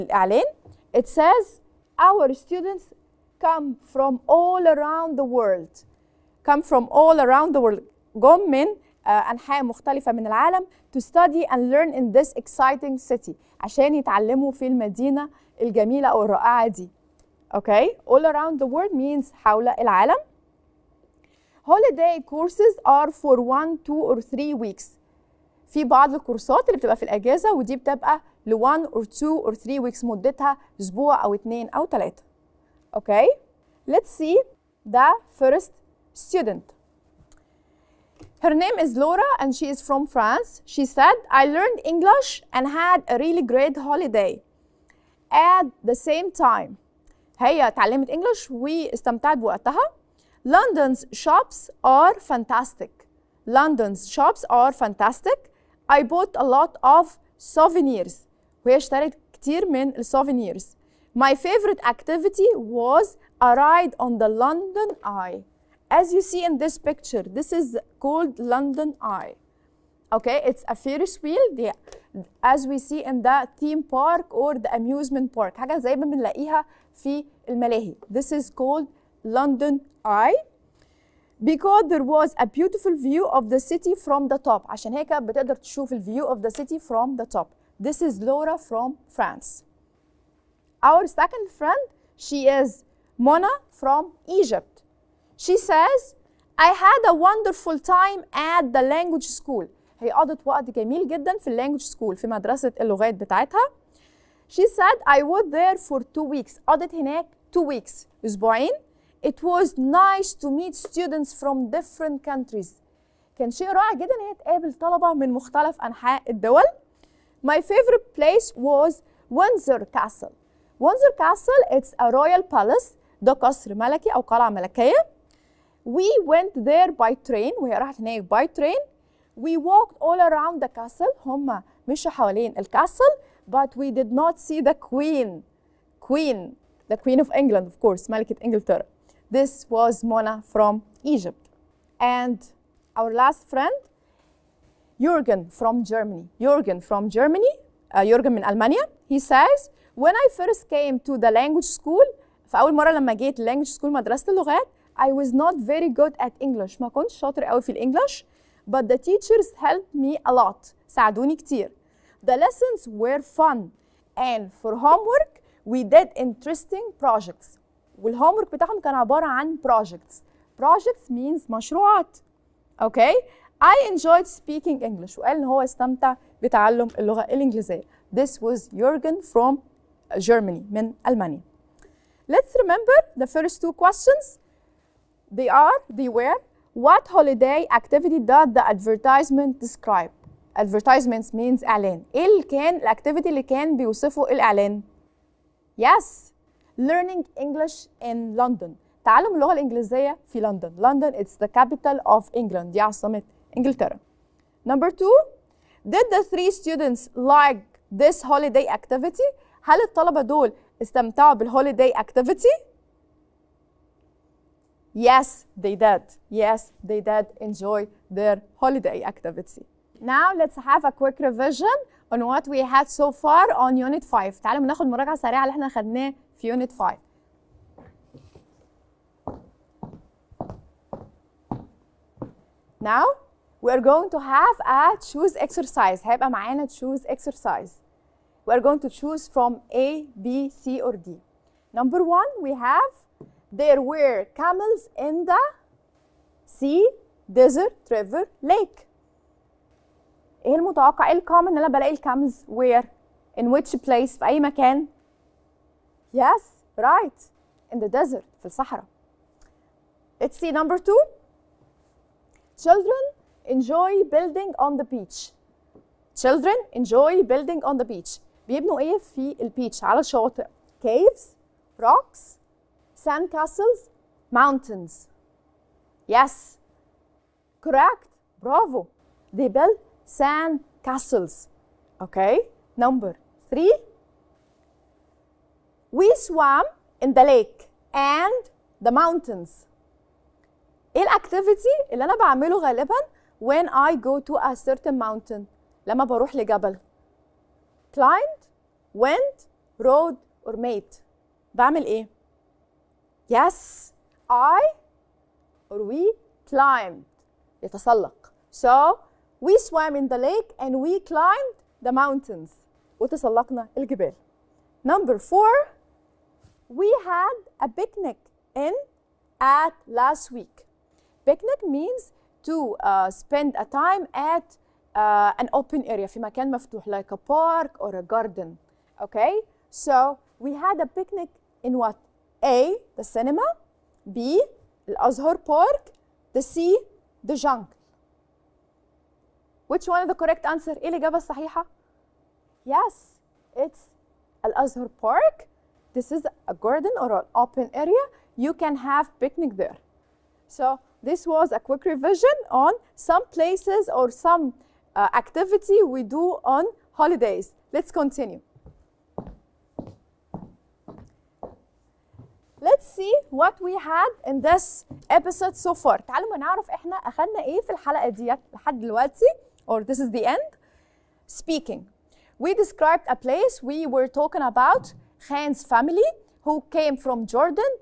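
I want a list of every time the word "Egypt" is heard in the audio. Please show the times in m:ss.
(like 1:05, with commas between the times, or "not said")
1:34, 2:21.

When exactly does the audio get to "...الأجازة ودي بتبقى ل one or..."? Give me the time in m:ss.
0:27.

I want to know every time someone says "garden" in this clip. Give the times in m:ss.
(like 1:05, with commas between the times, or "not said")
5:28, 5:46.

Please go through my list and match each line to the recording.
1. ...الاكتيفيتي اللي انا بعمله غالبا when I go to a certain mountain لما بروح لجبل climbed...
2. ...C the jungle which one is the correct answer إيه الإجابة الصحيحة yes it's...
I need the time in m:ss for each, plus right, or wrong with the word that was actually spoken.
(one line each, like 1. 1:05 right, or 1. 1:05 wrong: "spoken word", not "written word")
1. 4:51 right
2. 5:36 right.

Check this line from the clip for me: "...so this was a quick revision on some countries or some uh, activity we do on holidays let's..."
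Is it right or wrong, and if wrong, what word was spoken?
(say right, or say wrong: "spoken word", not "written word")
wrong: "places", not "countries".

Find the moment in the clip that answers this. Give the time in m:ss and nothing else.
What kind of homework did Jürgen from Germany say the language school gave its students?
2:46.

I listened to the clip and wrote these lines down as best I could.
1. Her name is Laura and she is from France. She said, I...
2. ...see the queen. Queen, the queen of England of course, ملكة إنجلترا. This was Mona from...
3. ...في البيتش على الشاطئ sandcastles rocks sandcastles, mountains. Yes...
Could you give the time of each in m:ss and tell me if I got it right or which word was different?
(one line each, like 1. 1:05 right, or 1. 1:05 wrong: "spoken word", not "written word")
1. 0:38 right
2. 2:14 right
3. 4:28 wrong: "caves", not "sandcastles".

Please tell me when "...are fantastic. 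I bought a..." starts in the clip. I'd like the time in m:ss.
0:54.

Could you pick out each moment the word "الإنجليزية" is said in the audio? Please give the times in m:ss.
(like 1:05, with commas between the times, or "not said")
2:57, 3:19.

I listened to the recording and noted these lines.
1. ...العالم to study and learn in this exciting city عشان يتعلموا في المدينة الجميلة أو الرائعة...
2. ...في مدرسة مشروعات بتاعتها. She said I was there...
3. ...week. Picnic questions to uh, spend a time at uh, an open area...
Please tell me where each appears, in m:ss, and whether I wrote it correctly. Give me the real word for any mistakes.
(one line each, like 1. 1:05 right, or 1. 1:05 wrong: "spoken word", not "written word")
1. 0:10 right
2. 1:42 wrong: "اللغات", not "مشروعات"
3. 5:20 wrong: "means", not "questions".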